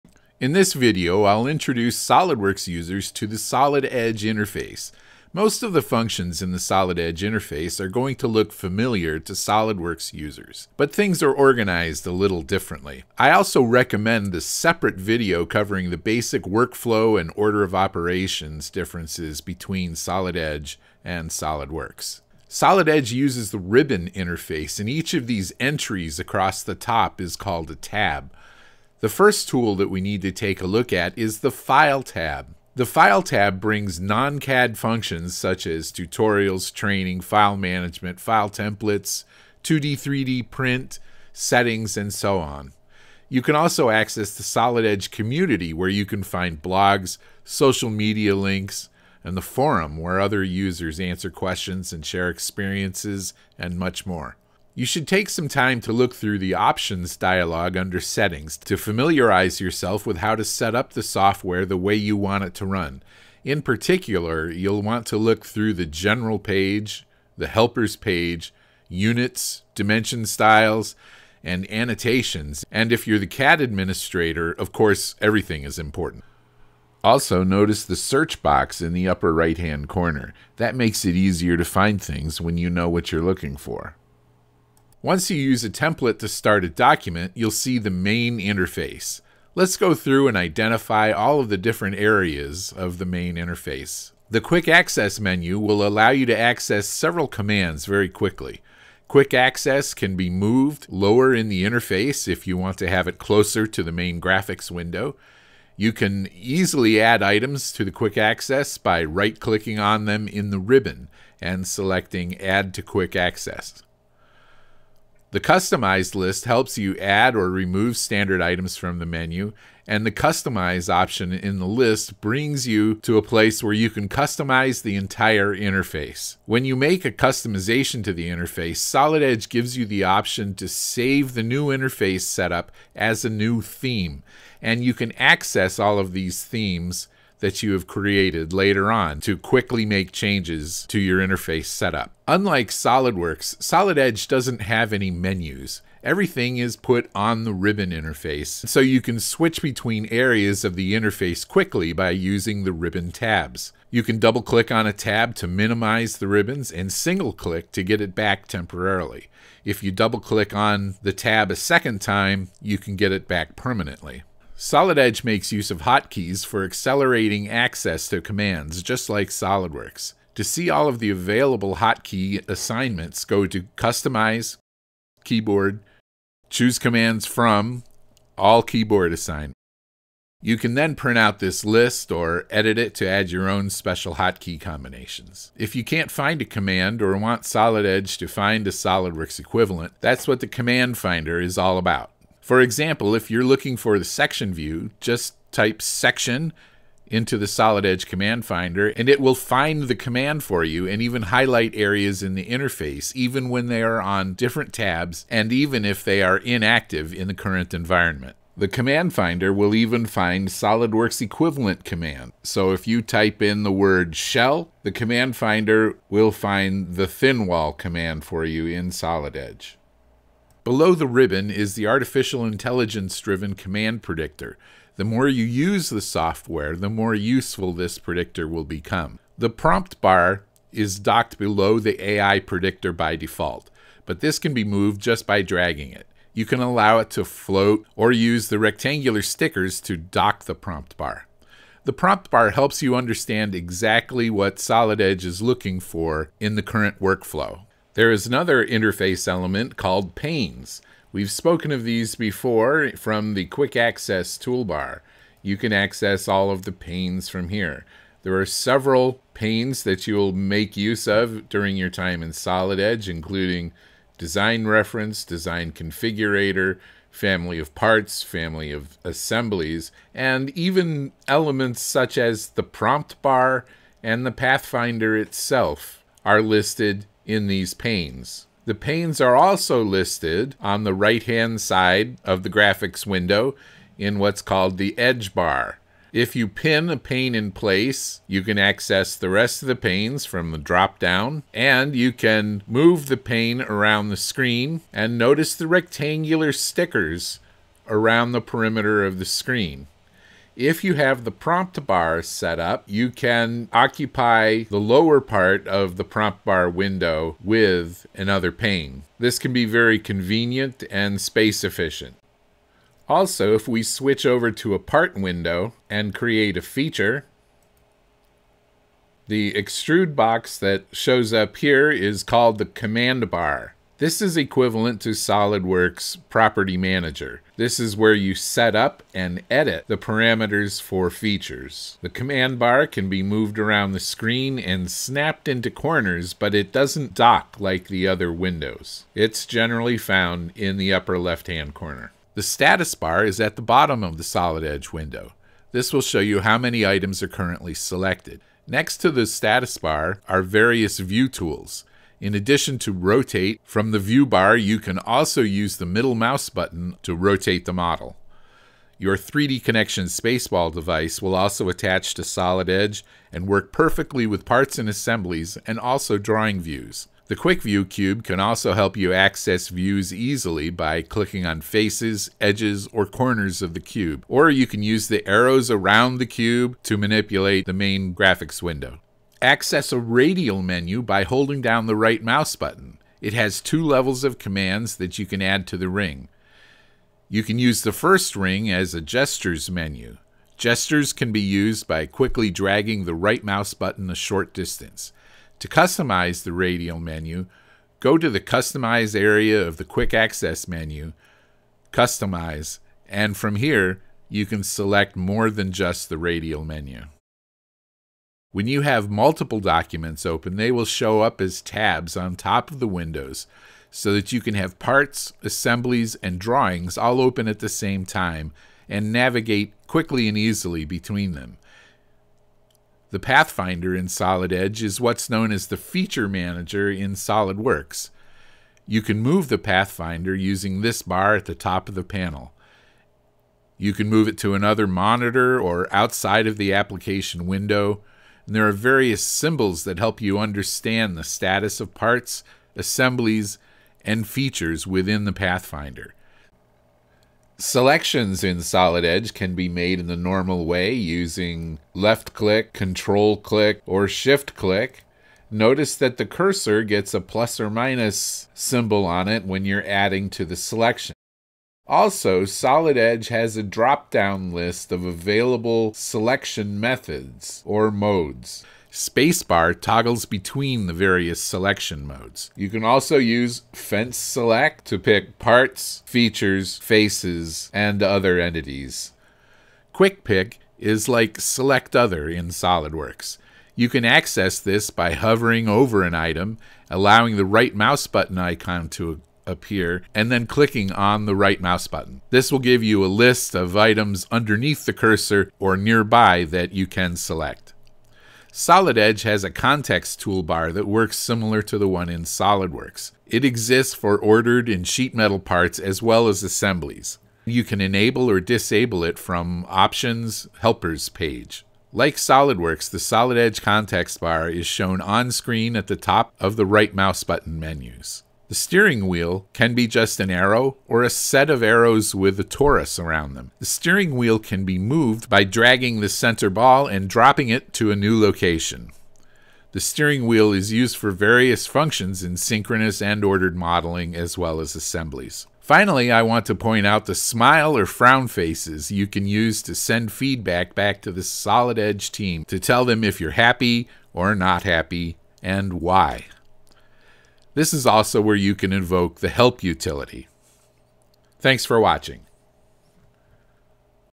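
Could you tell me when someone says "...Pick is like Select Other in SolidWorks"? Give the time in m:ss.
8:00.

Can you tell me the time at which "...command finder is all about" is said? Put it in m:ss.
3:10.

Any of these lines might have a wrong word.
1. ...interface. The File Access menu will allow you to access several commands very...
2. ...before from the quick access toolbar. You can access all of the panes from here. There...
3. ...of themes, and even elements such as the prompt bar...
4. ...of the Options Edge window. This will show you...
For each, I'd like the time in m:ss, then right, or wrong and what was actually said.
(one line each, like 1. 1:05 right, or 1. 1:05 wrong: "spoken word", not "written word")
1. 1:33 wrong: "Quick", not "File"
2. 4:12 right
3. 4:28 wrong: "assemblies", not "themes"
4. 5:44 wrong: "Solid", not "Options".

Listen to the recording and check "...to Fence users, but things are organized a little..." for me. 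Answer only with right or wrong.
wrong.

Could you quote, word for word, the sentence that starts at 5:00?
If you have the prompt bar set up, you can occupy the lower part of the prompt bar window with another pane.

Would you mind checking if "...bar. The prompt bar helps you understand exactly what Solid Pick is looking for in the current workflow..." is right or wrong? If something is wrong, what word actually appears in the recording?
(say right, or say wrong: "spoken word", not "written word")
wrong: "Edge", not "Pick".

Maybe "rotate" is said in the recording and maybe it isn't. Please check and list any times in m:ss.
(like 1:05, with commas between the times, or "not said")
5:52, 5:57.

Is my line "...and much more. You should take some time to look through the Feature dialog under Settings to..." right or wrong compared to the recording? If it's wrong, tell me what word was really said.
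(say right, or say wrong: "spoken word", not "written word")
wrong: "Options", not "Feature".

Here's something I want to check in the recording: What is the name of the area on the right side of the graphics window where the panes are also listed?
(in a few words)
Edge bar.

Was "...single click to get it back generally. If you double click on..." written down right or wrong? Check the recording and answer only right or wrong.
wrong.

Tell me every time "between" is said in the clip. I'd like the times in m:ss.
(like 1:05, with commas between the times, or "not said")
0:19, 2:29, 7:00, 7:50.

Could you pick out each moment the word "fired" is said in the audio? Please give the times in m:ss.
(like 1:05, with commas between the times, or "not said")
not said.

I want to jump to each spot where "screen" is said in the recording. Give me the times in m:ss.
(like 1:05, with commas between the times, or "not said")
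4:54, 4:59, 5:33, 8:35.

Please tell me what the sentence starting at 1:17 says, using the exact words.
Also, notice the search box in the upper right-hand corner.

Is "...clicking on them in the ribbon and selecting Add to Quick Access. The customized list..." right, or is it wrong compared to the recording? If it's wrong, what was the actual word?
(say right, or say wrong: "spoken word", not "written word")
right.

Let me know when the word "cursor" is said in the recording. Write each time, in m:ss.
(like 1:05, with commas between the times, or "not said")
7:36, 8:14.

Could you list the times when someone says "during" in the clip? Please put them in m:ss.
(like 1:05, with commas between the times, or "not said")
4:21.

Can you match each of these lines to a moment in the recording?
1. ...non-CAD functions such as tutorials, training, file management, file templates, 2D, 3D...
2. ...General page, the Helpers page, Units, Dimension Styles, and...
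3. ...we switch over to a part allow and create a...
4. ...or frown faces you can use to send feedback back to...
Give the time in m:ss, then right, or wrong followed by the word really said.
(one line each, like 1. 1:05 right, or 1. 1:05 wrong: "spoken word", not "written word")
1. 0:33 right
2. 1:05 right
3. 5:13 wrong: "window", not "allow"
4. 8:57 right.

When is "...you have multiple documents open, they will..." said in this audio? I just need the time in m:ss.
6:48.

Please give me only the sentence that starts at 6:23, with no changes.
It has two levels of commands that you can add to the ring.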